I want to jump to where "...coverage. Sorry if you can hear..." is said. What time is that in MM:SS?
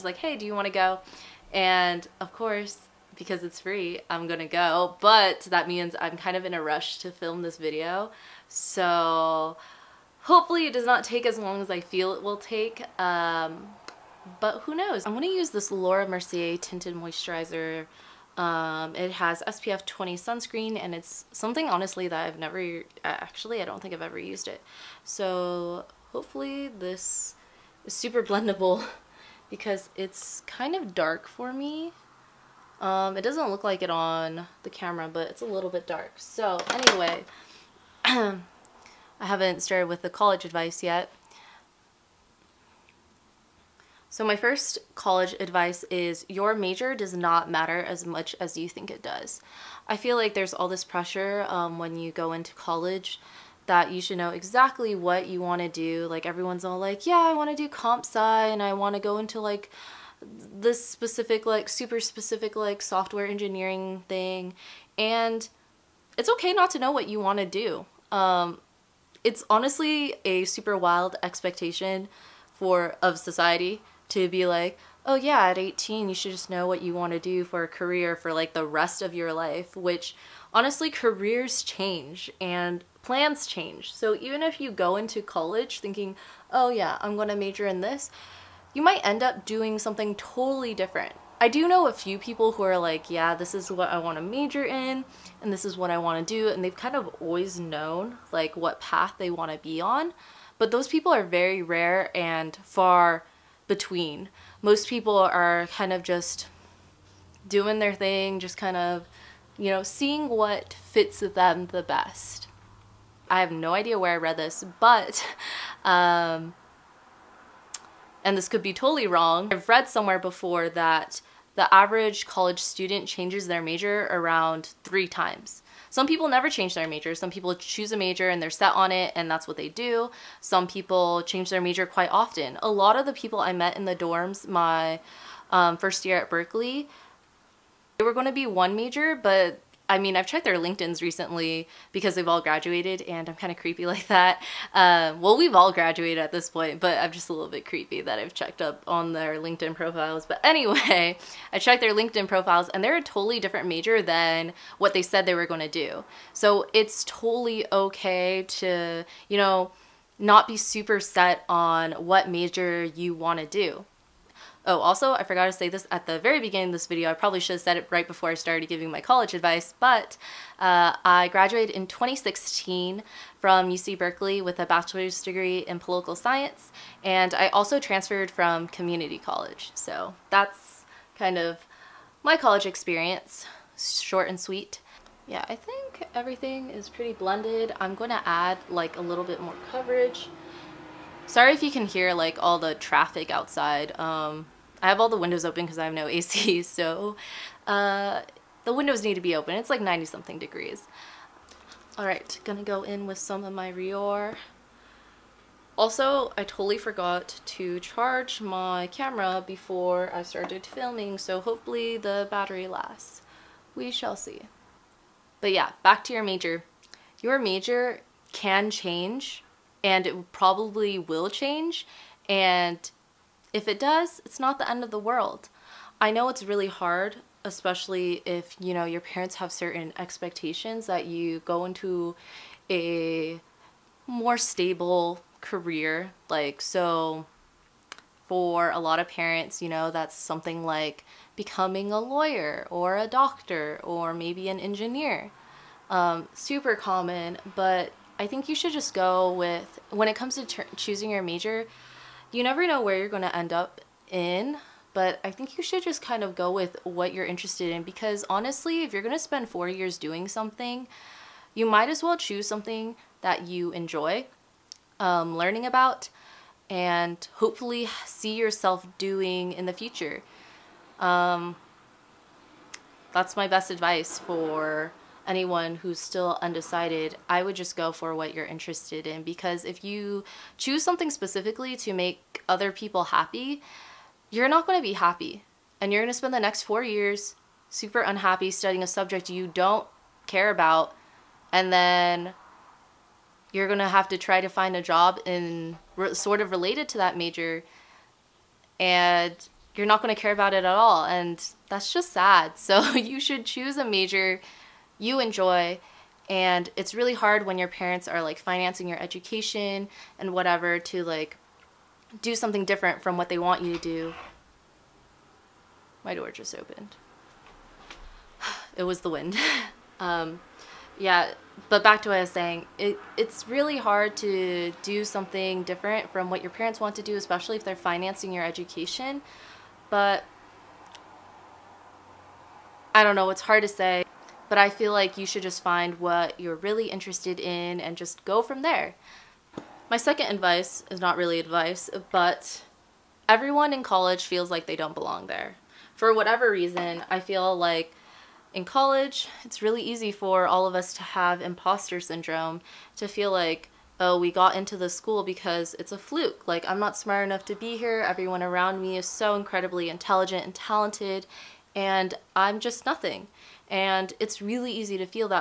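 03:09.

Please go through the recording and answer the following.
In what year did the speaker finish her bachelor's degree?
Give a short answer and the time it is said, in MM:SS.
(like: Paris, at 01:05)
2016, at 02:51.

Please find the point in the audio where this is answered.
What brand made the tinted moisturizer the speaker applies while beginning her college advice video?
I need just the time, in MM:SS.
00:15.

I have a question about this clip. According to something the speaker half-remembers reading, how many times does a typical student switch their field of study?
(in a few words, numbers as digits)
3.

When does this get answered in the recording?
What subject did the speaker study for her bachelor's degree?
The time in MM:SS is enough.
02:55.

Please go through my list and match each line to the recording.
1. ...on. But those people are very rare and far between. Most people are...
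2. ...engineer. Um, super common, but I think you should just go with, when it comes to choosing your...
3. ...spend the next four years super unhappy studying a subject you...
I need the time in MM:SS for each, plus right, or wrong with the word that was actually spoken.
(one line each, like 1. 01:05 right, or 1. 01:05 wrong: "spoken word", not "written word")
1. 01:39 right
2. 04:04 right
3. 04:46 right.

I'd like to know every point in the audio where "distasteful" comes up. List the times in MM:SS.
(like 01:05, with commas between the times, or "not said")
not said.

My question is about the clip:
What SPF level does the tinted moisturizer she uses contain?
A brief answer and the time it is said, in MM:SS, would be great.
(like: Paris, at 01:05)
20, at 00:19.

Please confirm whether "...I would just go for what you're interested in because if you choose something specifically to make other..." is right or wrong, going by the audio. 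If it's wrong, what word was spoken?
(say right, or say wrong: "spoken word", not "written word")
right.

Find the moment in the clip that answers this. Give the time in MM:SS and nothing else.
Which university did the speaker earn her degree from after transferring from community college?
02:53.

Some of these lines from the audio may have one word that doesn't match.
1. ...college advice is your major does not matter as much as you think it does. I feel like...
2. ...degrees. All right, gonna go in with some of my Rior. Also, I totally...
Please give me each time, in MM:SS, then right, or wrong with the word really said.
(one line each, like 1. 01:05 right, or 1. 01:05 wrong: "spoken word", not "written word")
1. 00:44 right
2. 03:20 right.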